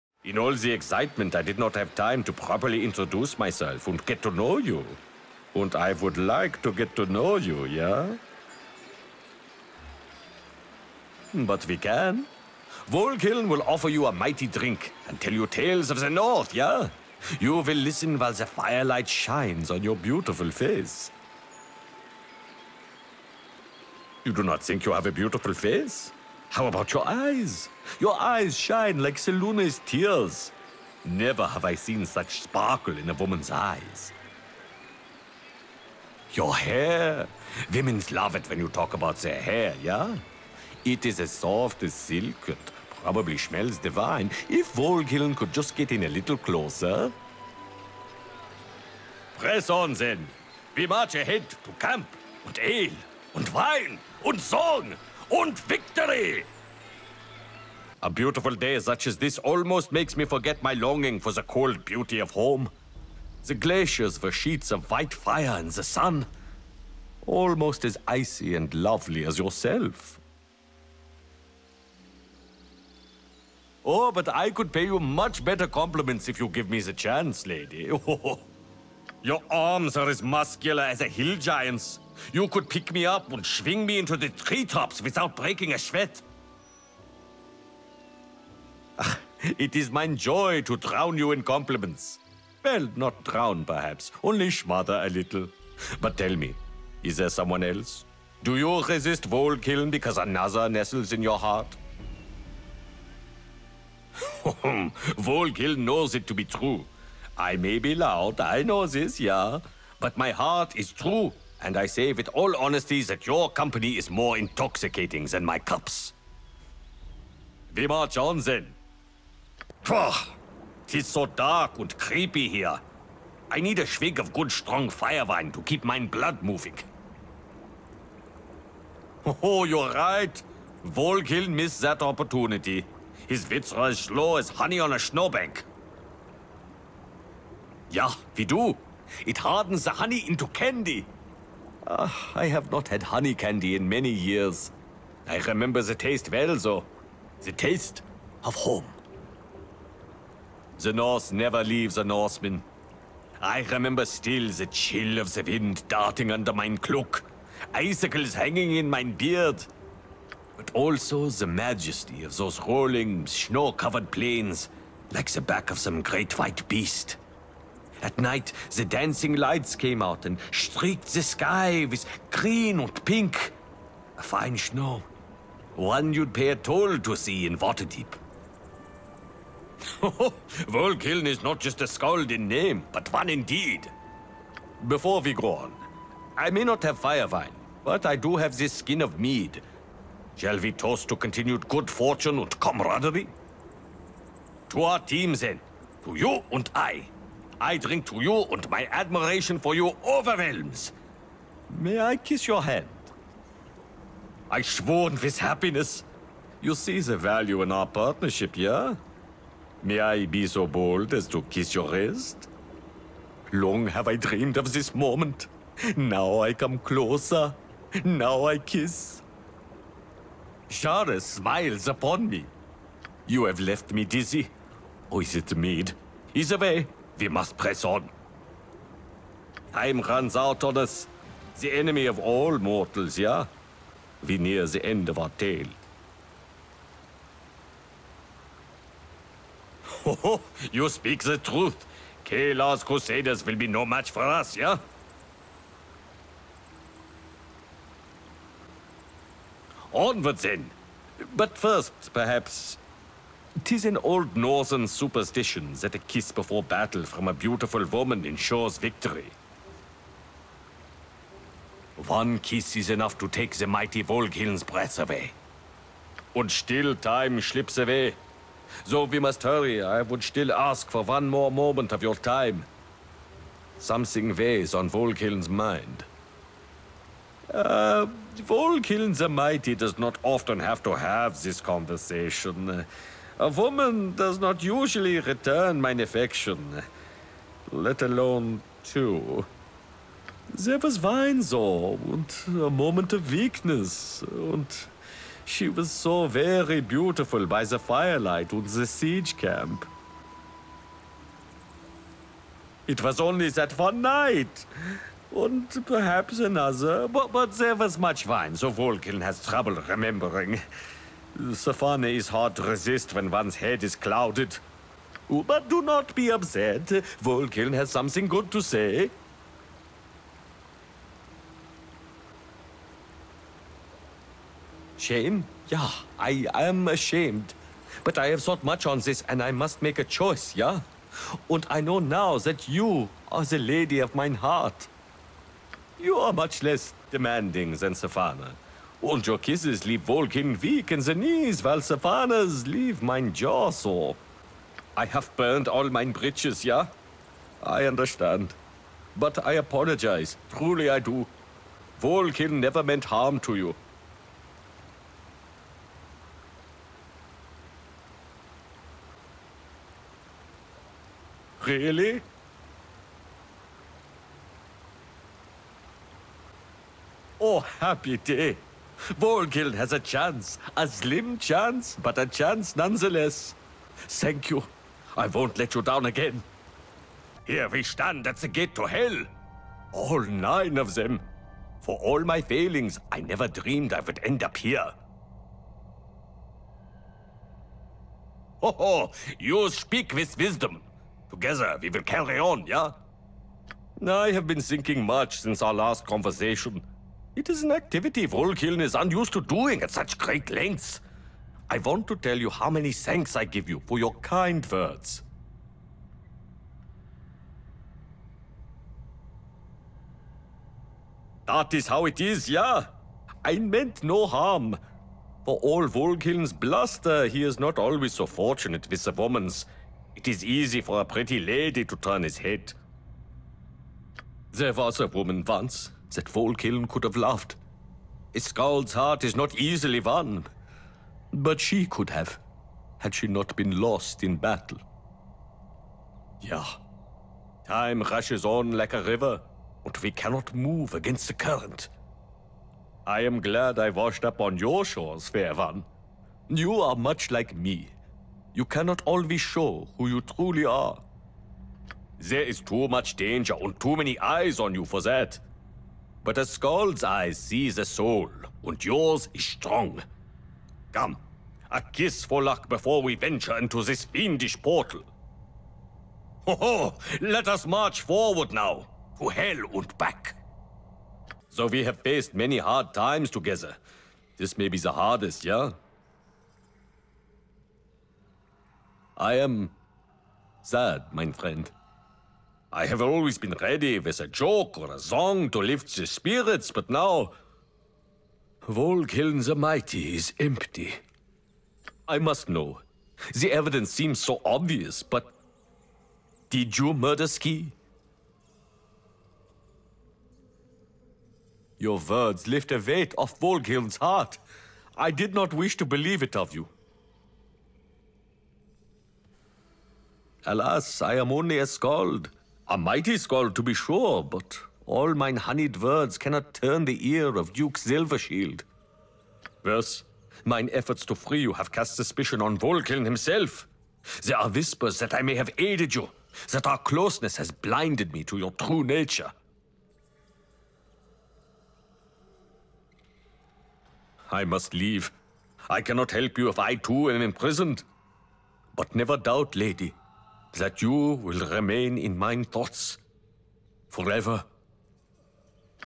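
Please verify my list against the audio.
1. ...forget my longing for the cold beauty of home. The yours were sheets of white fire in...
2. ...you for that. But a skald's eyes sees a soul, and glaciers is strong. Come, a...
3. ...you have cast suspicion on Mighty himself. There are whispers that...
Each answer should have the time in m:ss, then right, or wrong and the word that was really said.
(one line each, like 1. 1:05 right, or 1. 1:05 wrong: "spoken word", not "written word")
1. 1:00 wrong: "glaciers", not "yours"
2. 7:34 wrong: "yours", not "glaciers"
3. 8:41 wrong: "Voghiln", not "Mighty".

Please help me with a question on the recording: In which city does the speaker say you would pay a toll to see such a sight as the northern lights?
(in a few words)
Waterdeep.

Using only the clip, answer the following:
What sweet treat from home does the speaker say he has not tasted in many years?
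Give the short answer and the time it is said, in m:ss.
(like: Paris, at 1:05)
honey candy, at 2:23.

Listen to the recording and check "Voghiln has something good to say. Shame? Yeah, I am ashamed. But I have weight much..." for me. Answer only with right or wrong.
wrong.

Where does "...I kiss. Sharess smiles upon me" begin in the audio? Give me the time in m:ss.
3:38.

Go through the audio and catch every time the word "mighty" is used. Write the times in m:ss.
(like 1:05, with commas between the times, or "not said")
0:14, 4:23, 4:39, 8:09, 8:32.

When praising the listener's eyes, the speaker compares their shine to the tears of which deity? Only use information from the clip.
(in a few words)
Selune.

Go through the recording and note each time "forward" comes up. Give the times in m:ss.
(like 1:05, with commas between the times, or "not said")
7:48.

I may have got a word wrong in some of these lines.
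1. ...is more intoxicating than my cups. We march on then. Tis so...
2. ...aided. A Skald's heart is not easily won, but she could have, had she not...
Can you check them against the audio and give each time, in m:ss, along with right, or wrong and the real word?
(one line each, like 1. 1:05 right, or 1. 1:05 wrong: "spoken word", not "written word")
1. 1:53 right
2. 7:07 wrong: "loved", not "aided".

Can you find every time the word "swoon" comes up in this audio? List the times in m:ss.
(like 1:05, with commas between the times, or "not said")
3:24.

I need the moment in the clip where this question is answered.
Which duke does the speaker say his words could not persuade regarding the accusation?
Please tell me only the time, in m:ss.
8:37.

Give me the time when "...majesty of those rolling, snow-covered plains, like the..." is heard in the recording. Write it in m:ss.
2:41.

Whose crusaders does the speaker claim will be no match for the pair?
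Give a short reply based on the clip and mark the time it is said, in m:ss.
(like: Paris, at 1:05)
Caelar, at 4:02.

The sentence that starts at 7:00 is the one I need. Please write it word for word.
It is easy for a pretty lady to turn his head.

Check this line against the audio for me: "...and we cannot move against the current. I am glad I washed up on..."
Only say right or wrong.
right.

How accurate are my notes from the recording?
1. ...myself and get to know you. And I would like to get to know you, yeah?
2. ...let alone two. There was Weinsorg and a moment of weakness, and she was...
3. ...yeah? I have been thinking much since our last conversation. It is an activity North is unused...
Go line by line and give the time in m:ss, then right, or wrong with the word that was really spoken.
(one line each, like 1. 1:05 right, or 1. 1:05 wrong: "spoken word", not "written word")
1. 0:03 right
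2. 4:47 right
3. 6:32 wrong: "Voghiln", not "North".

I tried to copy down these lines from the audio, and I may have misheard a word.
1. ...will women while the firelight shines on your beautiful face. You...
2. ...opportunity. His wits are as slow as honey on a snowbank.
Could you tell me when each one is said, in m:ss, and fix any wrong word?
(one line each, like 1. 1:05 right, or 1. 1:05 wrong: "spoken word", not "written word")
1. 0:17 wrong: "listen", not "women"
2. 2:12 right.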